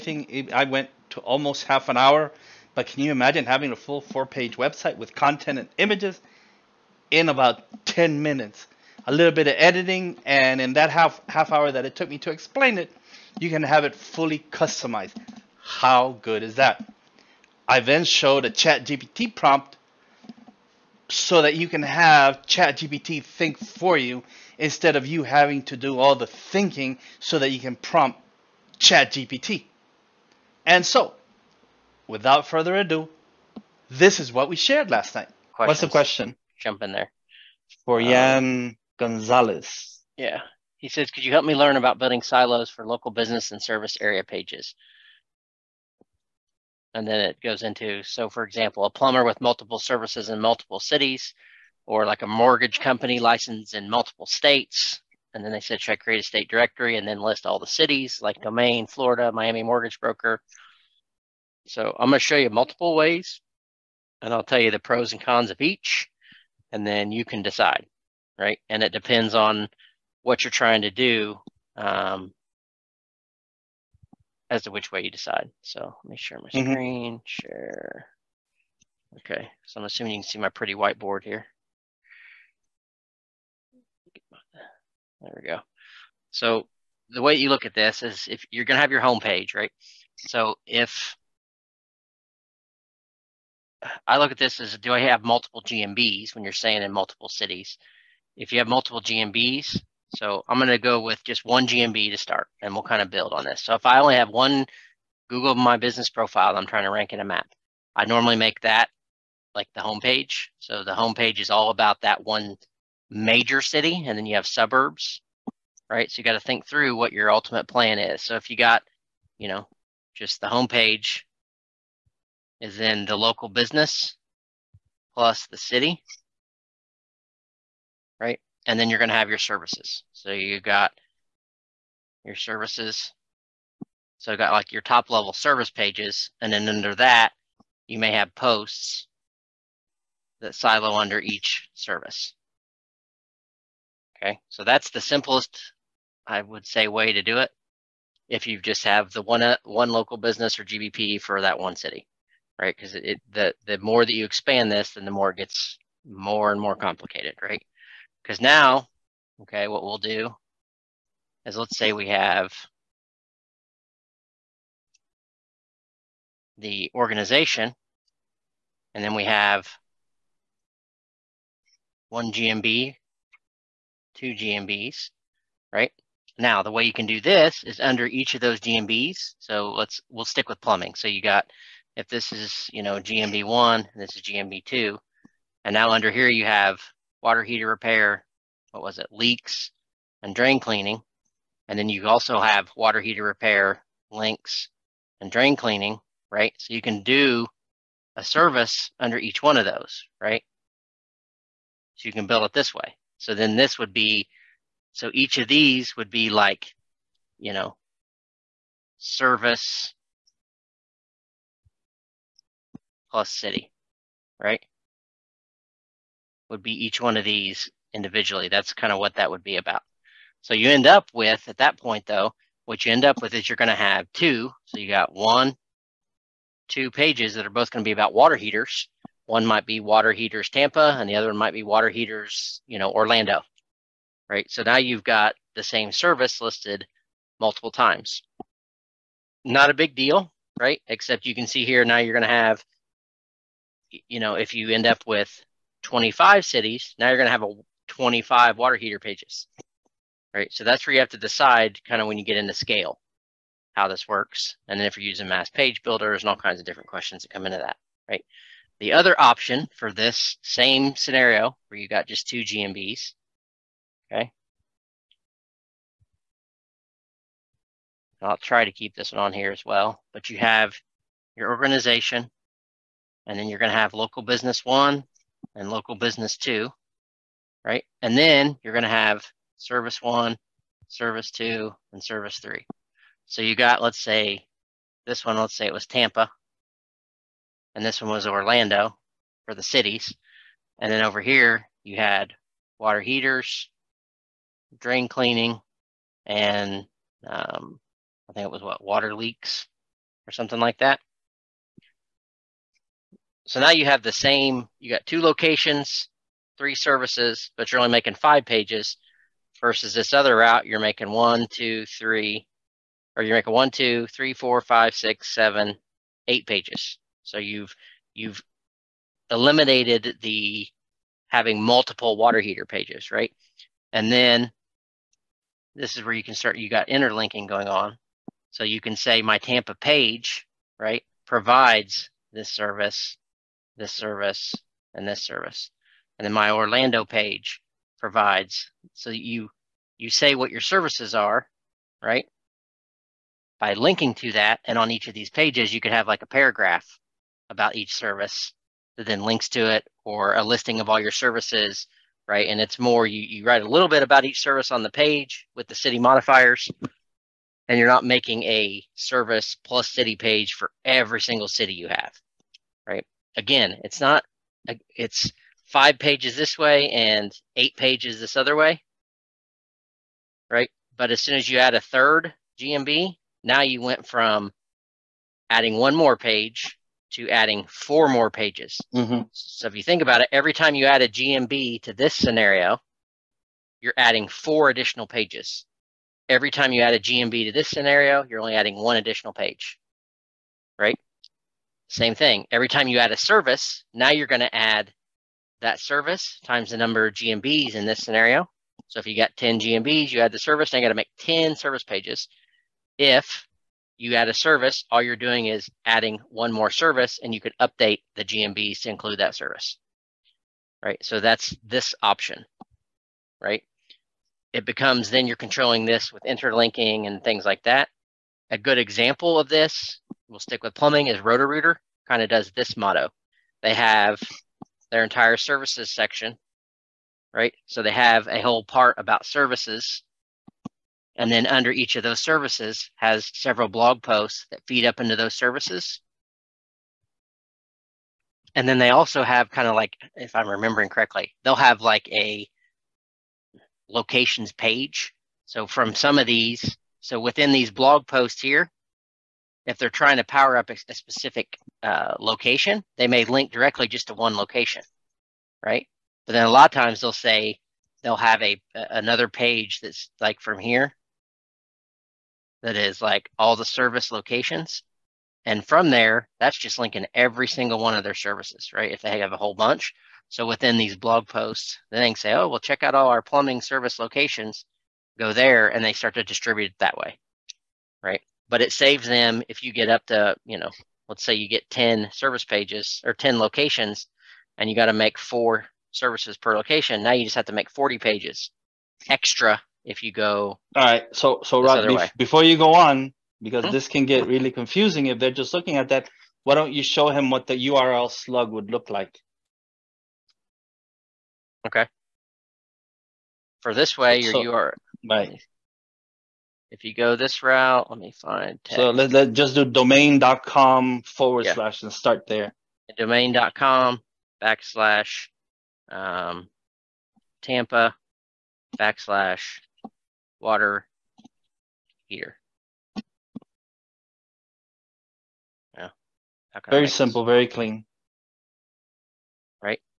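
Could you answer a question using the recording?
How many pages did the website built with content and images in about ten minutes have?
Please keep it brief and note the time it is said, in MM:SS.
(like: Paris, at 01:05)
4, at 00:04.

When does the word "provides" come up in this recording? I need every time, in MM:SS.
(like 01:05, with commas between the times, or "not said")
05:31, 05:37.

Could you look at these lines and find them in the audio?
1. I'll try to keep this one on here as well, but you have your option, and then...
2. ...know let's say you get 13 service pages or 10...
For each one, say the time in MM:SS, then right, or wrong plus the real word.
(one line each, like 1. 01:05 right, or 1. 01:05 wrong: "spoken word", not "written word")
1. 04:28 wrong: "organization", not "option"
2. 08:00 wrong: "10", not "13".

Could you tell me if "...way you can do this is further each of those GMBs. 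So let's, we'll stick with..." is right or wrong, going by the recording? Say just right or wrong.
wrong.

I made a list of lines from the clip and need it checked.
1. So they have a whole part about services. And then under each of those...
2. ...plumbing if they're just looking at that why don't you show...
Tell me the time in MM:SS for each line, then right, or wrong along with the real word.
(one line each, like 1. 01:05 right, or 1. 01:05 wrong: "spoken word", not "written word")
1. 07:07 right
2. 08:14 wrong: "confusing", not "plumbing".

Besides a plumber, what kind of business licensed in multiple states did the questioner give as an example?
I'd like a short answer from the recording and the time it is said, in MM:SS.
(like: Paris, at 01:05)
Mortgage company, at 00:52.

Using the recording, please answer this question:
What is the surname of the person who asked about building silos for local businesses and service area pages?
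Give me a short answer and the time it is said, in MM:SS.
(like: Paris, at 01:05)
Gonzalez, at 00:38.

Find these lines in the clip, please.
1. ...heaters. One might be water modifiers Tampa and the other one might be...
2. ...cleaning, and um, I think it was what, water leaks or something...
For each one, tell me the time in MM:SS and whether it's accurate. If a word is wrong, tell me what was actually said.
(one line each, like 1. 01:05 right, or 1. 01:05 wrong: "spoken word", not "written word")
1. 03:48 wrong: "heaters", not "modifiers"
2. 04:55 right.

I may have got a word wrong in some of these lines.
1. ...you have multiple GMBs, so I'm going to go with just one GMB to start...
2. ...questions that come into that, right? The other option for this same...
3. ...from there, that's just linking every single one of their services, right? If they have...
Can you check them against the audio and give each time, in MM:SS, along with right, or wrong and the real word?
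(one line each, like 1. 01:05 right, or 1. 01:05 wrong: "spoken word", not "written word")
1. 01:38 right
2. 04:16 right
3. 07:45 right.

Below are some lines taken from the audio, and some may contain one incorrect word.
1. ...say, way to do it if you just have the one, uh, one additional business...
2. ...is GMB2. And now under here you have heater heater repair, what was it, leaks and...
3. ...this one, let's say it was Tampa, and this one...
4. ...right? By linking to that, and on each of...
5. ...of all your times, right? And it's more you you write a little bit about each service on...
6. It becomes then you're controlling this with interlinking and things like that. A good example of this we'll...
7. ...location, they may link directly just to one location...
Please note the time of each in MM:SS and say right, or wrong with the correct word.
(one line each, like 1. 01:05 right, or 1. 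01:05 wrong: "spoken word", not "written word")
1. 02:26 wrong: "local", not "additional"
2. 03:04 wrong: "water", not "heater"
3. 04:45 right
4. 05:42 right
5. 05:50 wrong: "services", not "times"
6. 06:54 right
7. 07:32 right.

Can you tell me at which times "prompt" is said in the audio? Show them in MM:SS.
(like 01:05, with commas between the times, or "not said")
00:19, 00:27.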